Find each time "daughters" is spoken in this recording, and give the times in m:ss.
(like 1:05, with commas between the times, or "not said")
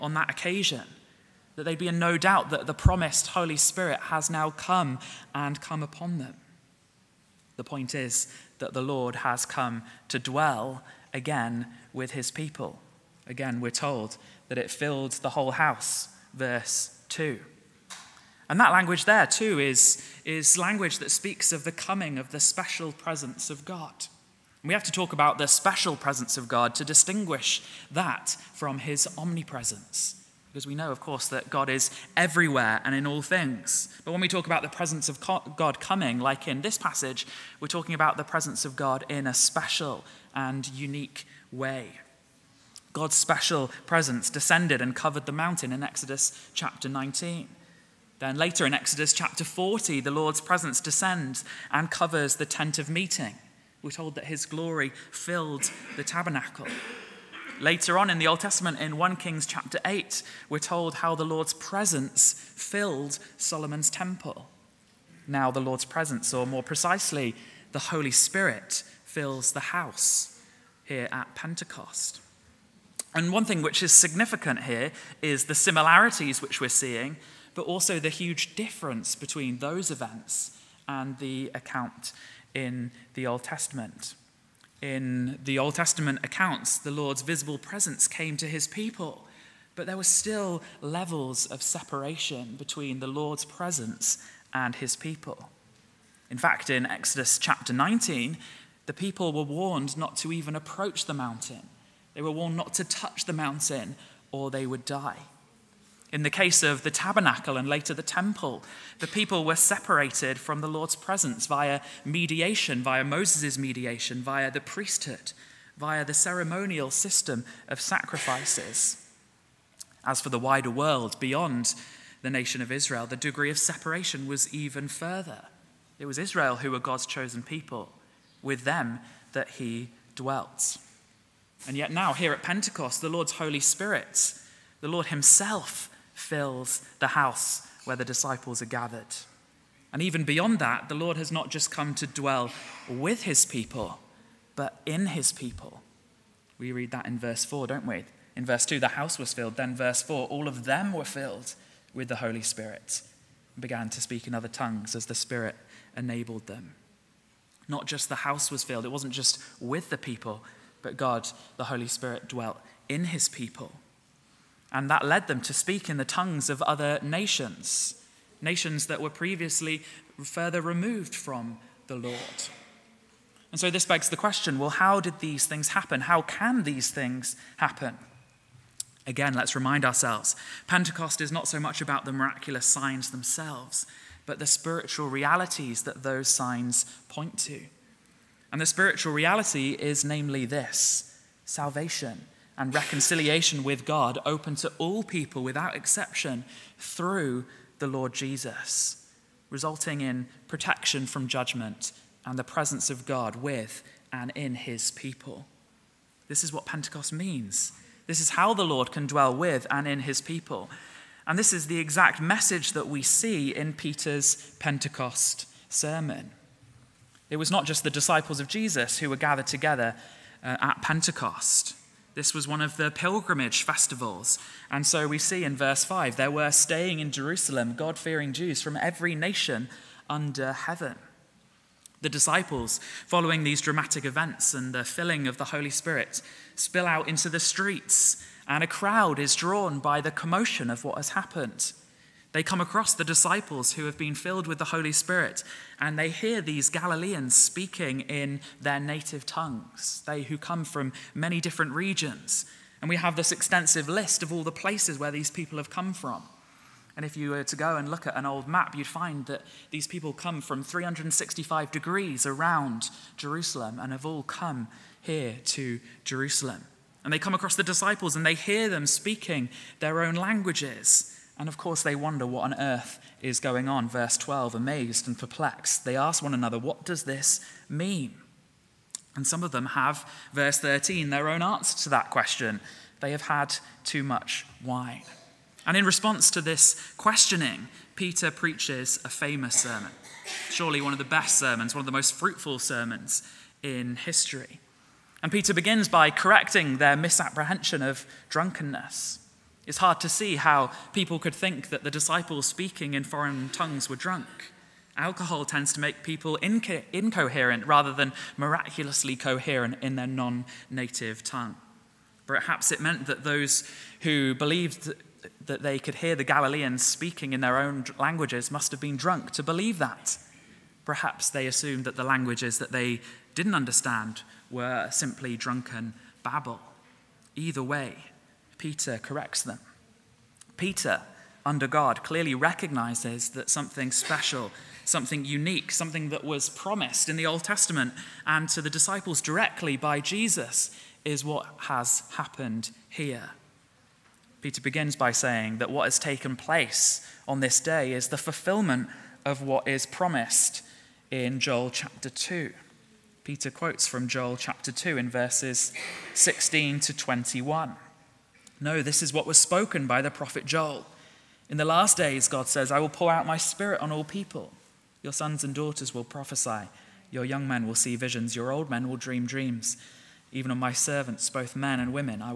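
6:05.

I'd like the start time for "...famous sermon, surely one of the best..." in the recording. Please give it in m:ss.
4:49.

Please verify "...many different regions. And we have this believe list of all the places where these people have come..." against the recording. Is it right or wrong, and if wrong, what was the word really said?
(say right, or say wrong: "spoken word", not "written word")
wrong: "extensive", not "believe".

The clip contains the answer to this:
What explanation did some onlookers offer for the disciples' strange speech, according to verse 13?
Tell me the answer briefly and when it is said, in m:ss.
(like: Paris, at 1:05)
Too much wine, at 4:43.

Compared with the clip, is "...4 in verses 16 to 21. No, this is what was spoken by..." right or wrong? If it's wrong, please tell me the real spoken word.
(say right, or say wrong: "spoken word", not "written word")
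wrong: "2", not "4".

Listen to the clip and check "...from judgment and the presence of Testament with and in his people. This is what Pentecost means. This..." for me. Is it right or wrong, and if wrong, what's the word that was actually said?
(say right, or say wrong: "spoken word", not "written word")
wrong: "God", not "Testament".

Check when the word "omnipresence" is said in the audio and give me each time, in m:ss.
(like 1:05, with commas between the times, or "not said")
0:29.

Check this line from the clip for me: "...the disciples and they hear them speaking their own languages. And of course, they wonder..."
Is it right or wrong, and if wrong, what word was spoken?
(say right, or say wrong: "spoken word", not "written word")
right.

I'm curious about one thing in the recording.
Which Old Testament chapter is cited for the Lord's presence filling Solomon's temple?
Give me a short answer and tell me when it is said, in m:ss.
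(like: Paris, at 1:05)
1 Kings 8, at 0:58.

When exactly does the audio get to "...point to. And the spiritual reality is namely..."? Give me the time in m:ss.
3:07.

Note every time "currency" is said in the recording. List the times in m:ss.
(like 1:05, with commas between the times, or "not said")
not said.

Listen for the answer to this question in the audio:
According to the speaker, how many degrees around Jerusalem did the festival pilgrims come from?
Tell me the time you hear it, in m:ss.
4:20.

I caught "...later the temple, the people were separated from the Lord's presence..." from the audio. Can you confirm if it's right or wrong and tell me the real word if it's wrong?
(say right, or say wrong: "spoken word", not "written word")
right.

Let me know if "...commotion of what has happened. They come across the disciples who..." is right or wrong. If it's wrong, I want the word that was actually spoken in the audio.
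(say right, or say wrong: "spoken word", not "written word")
right.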